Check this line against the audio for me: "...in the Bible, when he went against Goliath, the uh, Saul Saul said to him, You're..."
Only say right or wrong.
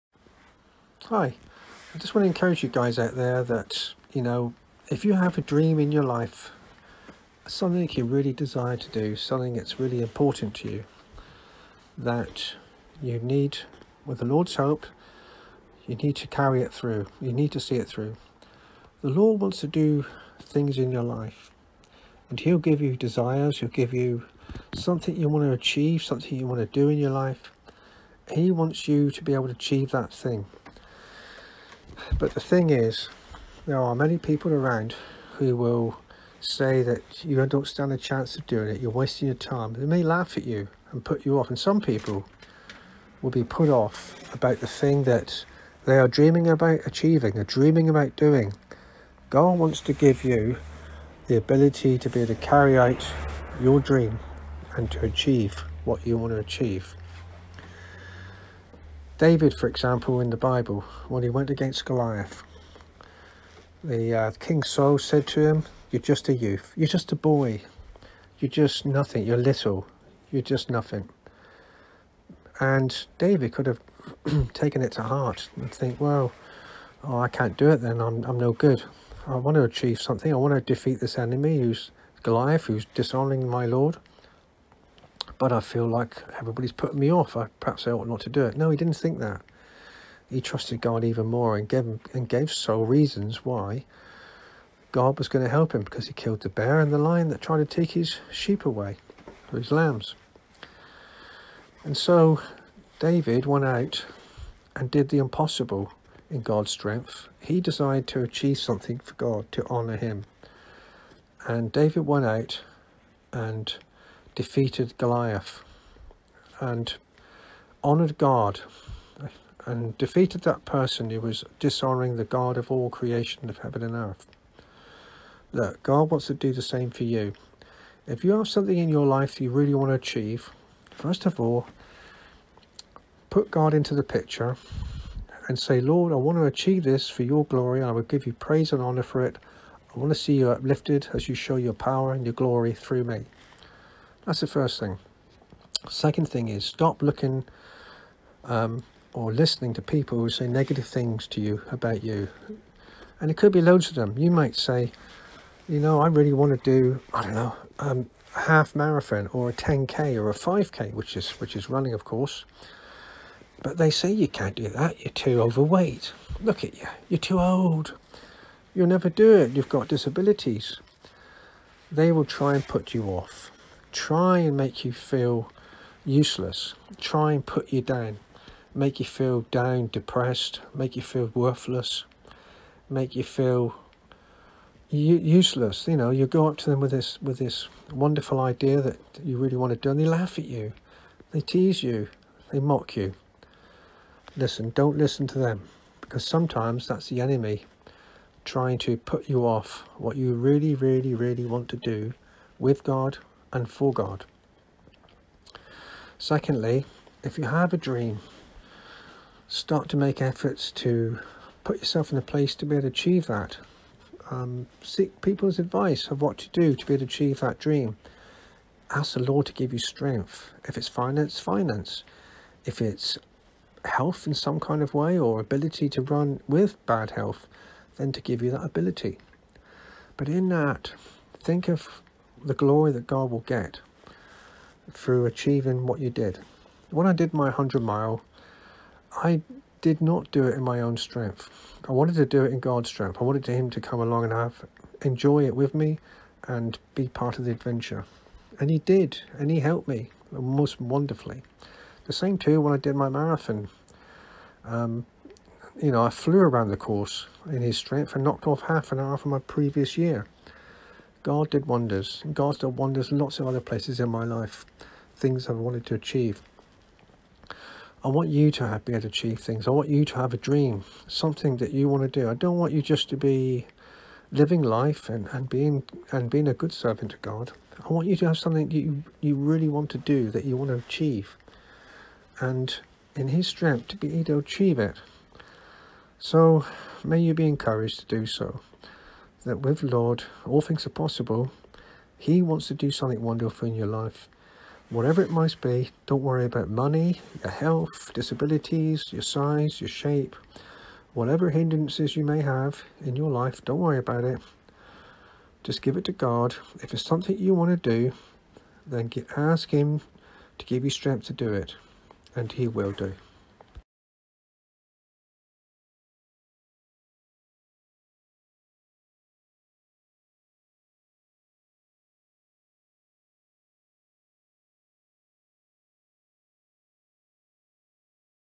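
wrong.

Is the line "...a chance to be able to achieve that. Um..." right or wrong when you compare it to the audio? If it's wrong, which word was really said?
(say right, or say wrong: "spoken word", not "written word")
wrong: "place", not "chance".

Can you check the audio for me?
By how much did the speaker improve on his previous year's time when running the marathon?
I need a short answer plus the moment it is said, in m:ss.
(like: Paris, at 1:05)
Half an hour, at 4:18.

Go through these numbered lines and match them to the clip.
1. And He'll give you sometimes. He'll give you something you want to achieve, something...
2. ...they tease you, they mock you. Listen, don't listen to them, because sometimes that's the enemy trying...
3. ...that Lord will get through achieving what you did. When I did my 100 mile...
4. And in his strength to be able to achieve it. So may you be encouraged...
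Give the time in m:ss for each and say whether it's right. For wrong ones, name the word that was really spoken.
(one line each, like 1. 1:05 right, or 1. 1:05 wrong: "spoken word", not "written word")
1. 0:22 wrong: "desires", not "sometimes"
2. 3:11 right
3. 3:52 wrong: "God", not "Lord"
4. 4:42 right.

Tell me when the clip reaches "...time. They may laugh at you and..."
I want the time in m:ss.
0:39.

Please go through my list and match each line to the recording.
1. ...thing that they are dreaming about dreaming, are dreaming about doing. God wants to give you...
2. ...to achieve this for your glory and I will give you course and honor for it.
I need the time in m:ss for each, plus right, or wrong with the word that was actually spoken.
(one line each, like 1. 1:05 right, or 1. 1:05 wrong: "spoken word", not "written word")
1. 0:44 wrong: "achieving", not "dreaming"
2. 2:16 wrong: "praise", not "course".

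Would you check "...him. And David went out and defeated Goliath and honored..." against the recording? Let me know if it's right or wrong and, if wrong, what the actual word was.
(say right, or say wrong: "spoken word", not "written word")
right.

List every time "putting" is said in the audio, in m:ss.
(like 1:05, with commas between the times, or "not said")
1:26.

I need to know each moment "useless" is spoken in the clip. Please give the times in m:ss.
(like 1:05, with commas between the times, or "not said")
2:56, 3:04.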